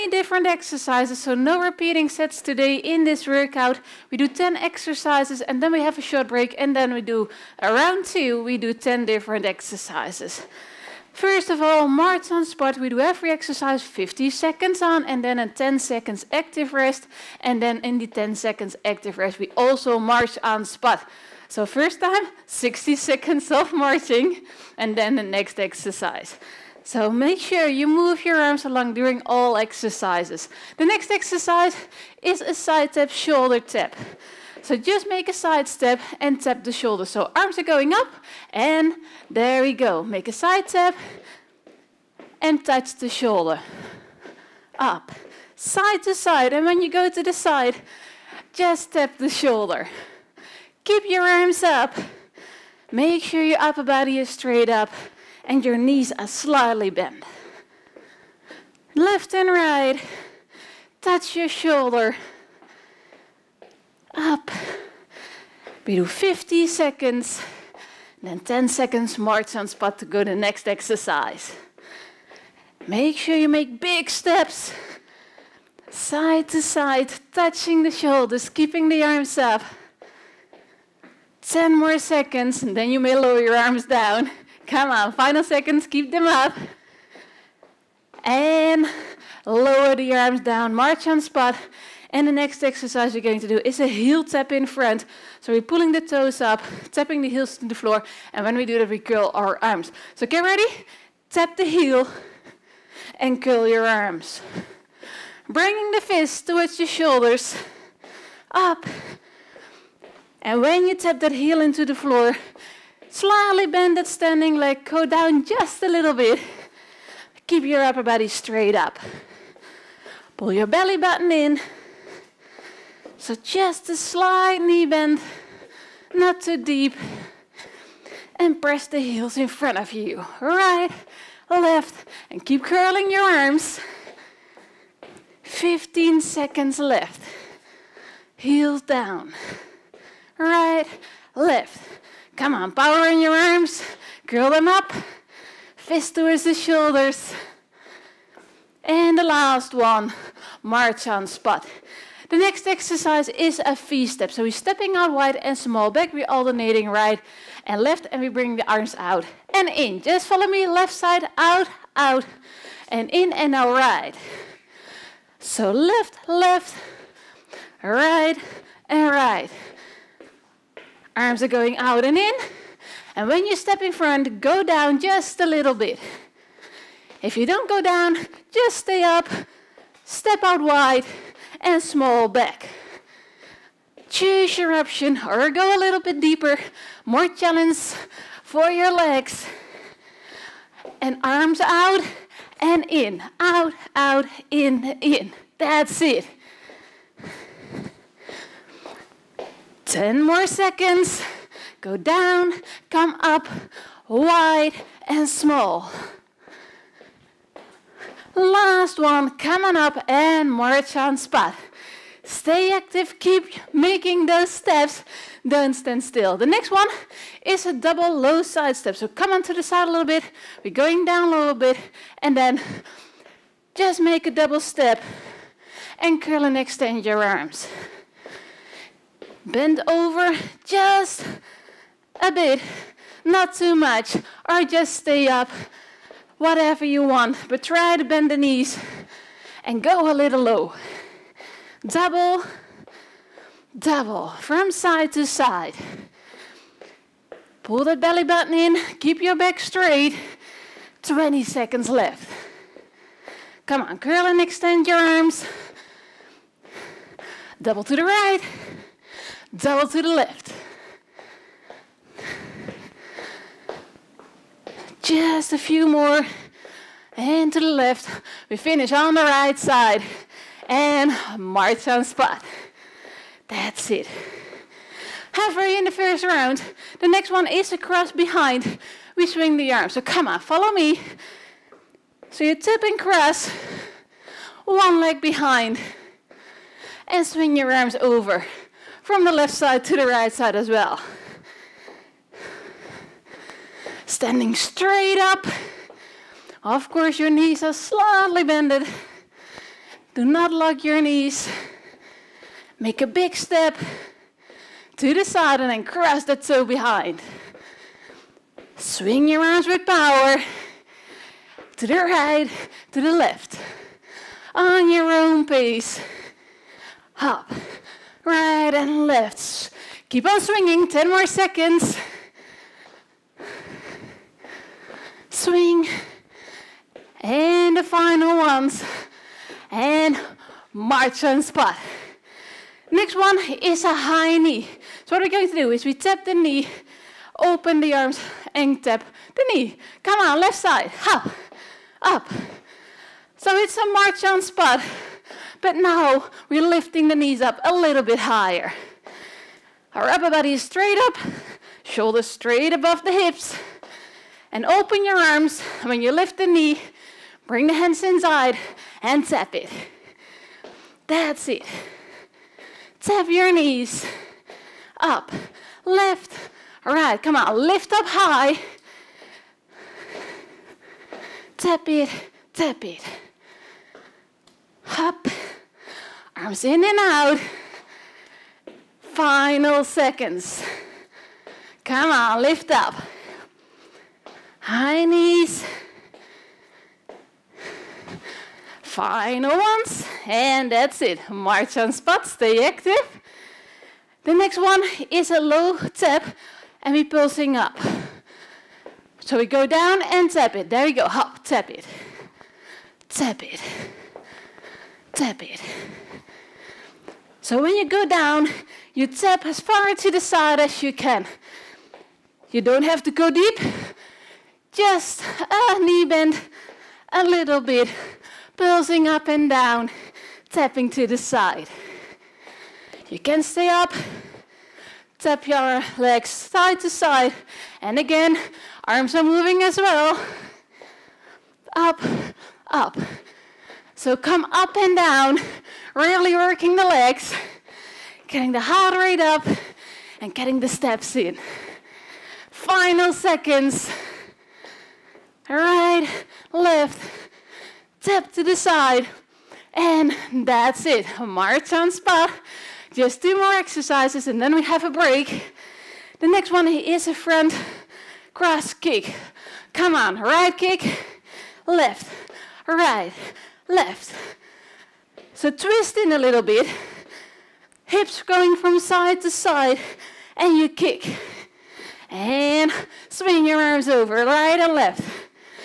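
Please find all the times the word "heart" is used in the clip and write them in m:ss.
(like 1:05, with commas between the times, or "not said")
7:18.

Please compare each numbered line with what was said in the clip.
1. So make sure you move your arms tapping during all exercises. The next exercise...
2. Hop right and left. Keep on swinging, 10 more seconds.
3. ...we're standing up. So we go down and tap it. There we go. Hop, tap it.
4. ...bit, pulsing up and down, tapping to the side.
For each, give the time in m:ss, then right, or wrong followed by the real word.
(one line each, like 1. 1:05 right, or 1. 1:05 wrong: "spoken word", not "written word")
1. 0:26 wrong: "along", not "tapping"
2. 5:17 right
3. 6:36 wrong: "pulsing", not "standing"
4. 6:57 right.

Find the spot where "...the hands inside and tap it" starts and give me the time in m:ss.
5:57.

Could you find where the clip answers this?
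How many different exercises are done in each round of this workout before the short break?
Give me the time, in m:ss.
0:04.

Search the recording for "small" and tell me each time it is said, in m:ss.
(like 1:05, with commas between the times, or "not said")
2:35, 3:01, 3:25.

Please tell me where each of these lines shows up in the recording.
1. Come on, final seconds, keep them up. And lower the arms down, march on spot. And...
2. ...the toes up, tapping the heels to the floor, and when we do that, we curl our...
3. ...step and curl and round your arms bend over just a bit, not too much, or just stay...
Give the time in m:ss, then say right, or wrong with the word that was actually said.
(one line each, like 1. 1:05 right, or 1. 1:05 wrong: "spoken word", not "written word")
1. 1:24 right
2. 1:35 right
3. 3:44 wrong: "extend", not "round".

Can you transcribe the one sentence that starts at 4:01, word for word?
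Double, double, from side to side.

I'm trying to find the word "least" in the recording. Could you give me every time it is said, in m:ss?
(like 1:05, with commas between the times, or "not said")
not said.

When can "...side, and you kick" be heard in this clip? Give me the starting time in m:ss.
7:49.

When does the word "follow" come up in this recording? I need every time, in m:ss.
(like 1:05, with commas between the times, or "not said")
2:40, 4:40.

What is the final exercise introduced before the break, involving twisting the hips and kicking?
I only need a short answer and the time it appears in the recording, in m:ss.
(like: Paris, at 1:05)
front cross kick, at 7:37.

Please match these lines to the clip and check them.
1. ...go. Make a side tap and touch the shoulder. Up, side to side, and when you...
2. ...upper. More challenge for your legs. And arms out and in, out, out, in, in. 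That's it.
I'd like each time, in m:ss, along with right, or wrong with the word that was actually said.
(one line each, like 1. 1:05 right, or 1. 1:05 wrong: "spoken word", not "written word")
1. 0:39 right
2. 3:06 wrong: "deeper", not "upper".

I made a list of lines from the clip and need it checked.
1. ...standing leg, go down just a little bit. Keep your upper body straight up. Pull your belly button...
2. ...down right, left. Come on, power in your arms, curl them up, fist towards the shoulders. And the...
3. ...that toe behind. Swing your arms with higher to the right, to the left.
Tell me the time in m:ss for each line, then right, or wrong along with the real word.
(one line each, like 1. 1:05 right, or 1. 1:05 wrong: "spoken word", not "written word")
1. 1:54 right
2. 2:18 right
3. 5:06 wrong: "power", not "higher".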